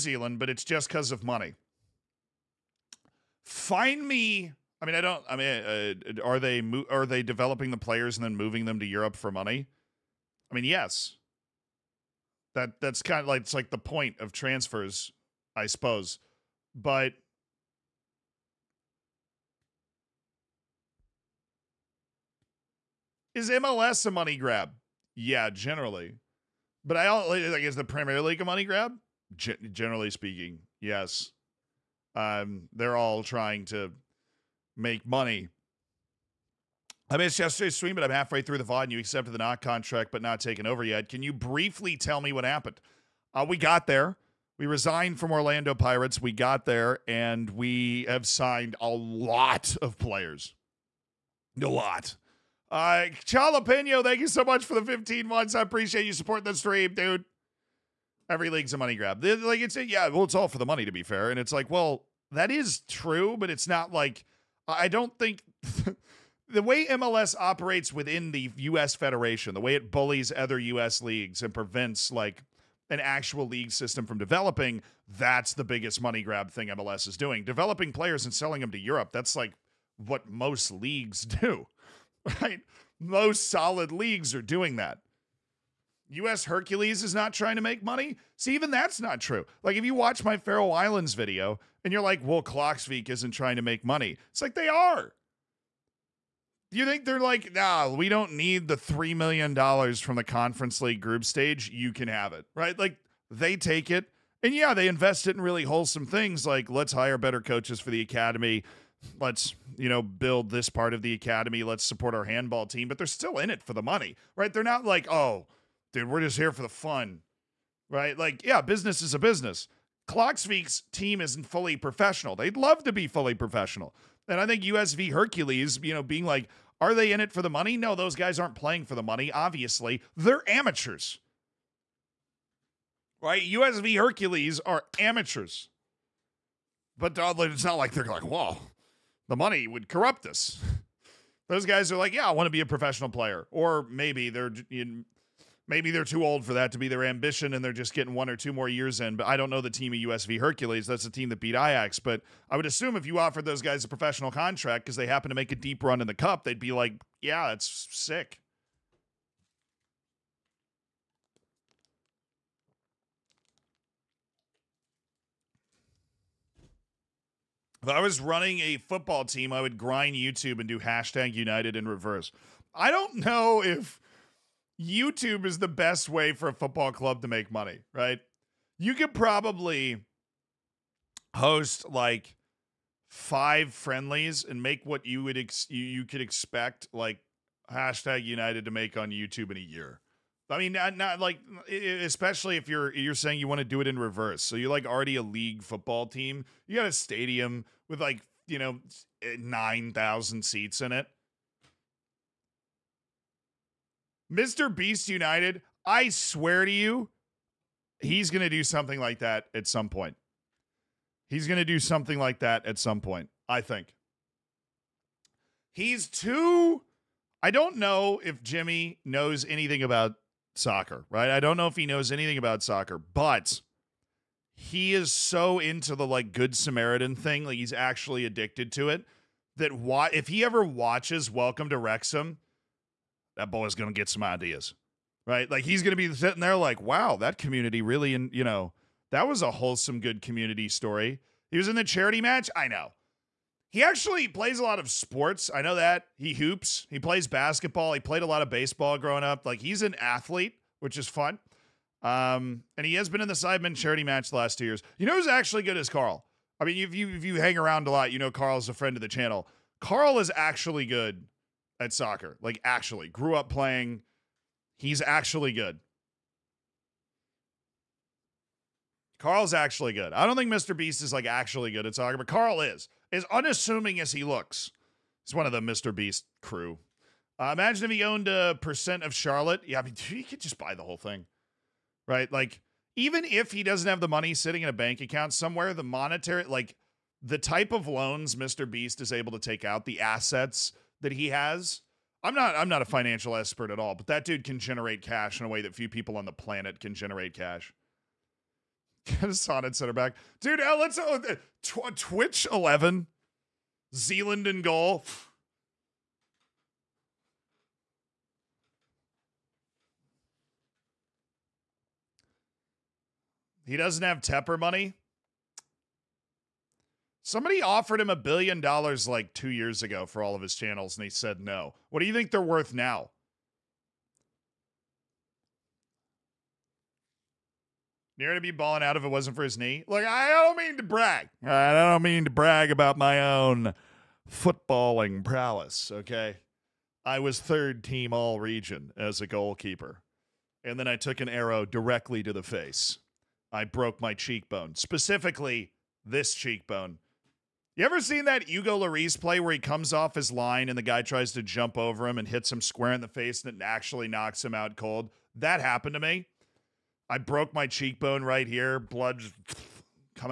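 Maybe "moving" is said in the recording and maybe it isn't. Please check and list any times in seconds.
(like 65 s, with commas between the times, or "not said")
8 s.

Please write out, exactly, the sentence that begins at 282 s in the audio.
Like, even if he doesn't have the money sitting in a bank account somewhere, the monetary, like, the type of loans Mr.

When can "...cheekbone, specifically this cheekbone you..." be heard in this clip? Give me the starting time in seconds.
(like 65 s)
344 s.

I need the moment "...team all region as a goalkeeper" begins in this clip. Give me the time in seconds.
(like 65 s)
337 s.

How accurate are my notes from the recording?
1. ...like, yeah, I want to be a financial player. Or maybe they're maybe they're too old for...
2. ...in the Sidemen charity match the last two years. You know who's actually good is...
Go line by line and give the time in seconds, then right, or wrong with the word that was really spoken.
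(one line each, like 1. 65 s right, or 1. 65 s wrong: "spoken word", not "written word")
1. 141 s wrong: "professional", not "financial"
2. 253 s right.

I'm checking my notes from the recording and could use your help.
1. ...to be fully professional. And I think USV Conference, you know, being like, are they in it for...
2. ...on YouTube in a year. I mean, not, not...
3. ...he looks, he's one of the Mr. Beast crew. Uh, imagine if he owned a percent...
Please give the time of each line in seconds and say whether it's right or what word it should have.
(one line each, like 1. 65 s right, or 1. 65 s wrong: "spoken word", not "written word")
1. 122 s wrong: "Hercules", not "Conference"
2. 188 s right
3. 274 s right.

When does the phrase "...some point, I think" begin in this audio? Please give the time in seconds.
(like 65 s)
212 s.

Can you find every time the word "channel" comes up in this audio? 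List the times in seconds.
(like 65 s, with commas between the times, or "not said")
259 s, 320 s.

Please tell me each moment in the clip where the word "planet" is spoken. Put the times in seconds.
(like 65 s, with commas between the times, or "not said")
296 s.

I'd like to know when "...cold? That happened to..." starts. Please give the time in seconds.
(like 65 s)
354 s.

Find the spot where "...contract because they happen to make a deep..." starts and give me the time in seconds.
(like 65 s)
154 s.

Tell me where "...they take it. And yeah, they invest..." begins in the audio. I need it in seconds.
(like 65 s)
103 s.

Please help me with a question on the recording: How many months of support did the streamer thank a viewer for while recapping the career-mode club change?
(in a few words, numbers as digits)
15.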